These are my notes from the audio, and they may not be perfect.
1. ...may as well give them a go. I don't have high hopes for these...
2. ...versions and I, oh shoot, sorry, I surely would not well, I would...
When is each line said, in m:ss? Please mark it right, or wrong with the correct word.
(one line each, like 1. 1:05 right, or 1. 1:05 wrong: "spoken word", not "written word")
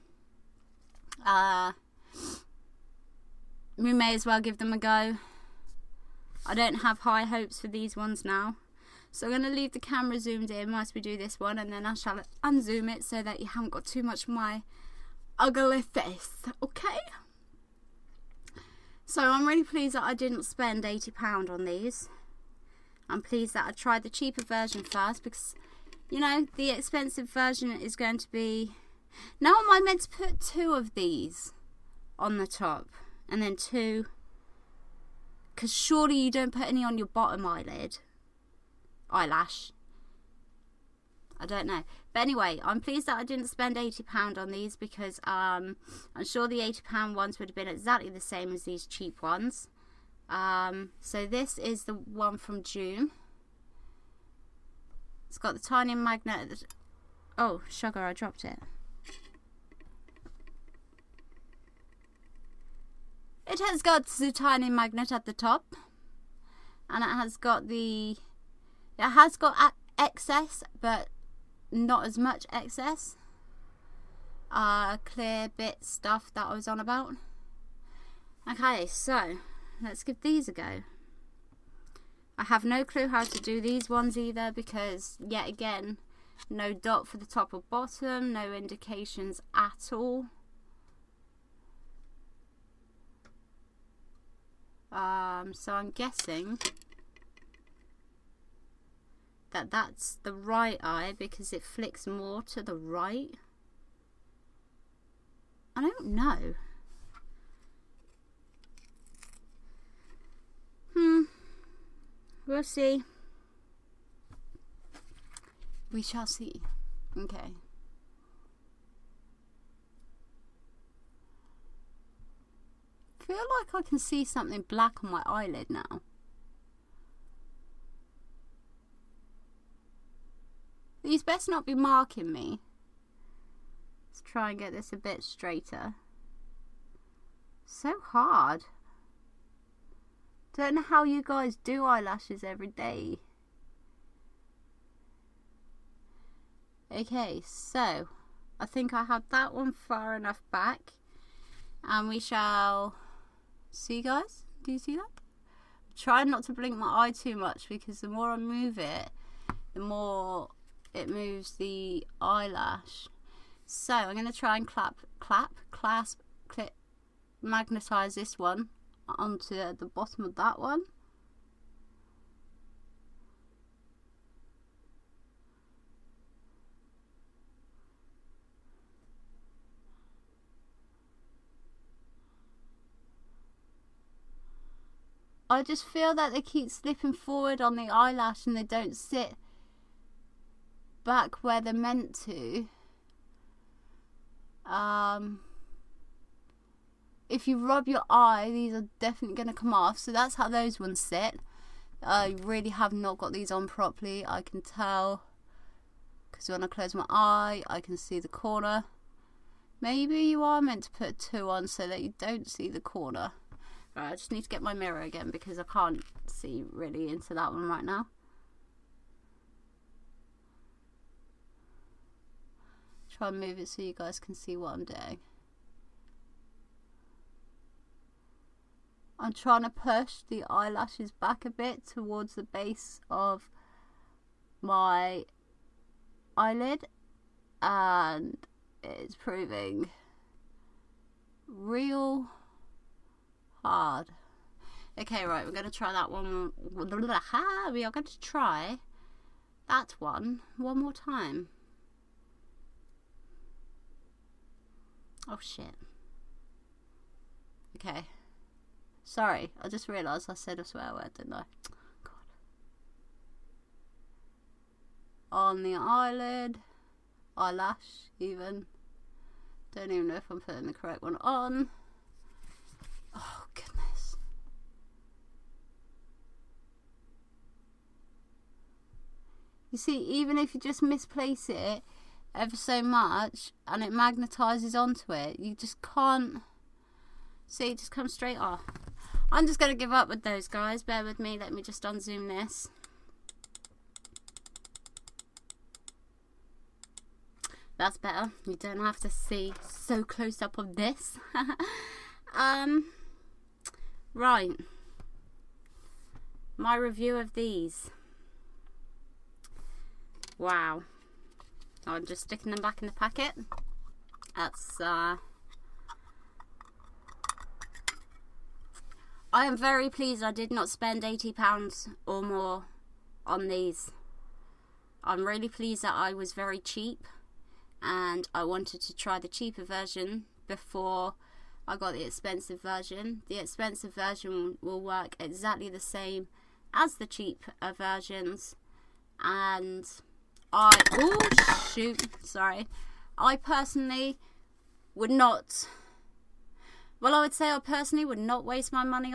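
1. 0:03 right
2. 5:37 wrong: "personally", not "surely".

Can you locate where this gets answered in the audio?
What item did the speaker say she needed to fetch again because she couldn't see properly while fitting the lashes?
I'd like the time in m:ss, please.
3:34.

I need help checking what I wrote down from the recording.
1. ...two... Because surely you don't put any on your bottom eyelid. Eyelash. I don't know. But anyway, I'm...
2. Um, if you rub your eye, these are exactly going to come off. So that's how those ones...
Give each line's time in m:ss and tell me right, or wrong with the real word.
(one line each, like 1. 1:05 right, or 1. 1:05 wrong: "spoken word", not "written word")
1. 0:33 right
2. 3:14 wrong: "definitely", not "exactly".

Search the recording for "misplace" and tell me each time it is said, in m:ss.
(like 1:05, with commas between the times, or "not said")
4:40.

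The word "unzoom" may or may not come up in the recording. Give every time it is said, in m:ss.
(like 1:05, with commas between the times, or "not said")
0:12, 4:51.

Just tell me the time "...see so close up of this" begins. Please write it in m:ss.
4:59.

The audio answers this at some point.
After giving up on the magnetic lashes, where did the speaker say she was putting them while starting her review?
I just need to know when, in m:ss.
5:12.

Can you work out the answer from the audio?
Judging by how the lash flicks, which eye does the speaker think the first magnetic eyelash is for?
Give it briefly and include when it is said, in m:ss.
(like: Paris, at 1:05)
Right eye, at 1:40.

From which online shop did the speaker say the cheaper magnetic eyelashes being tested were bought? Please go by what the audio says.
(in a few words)
Joom.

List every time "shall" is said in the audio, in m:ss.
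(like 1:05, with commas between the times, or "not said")
0:11, 1:56, 2:32.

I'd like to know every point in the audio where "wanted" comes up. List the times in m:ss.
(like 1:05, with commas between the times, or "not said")
5:28.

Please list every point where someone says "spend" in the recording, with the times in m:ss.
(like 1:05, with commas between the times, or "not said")
0:20, 0:43, 5:20.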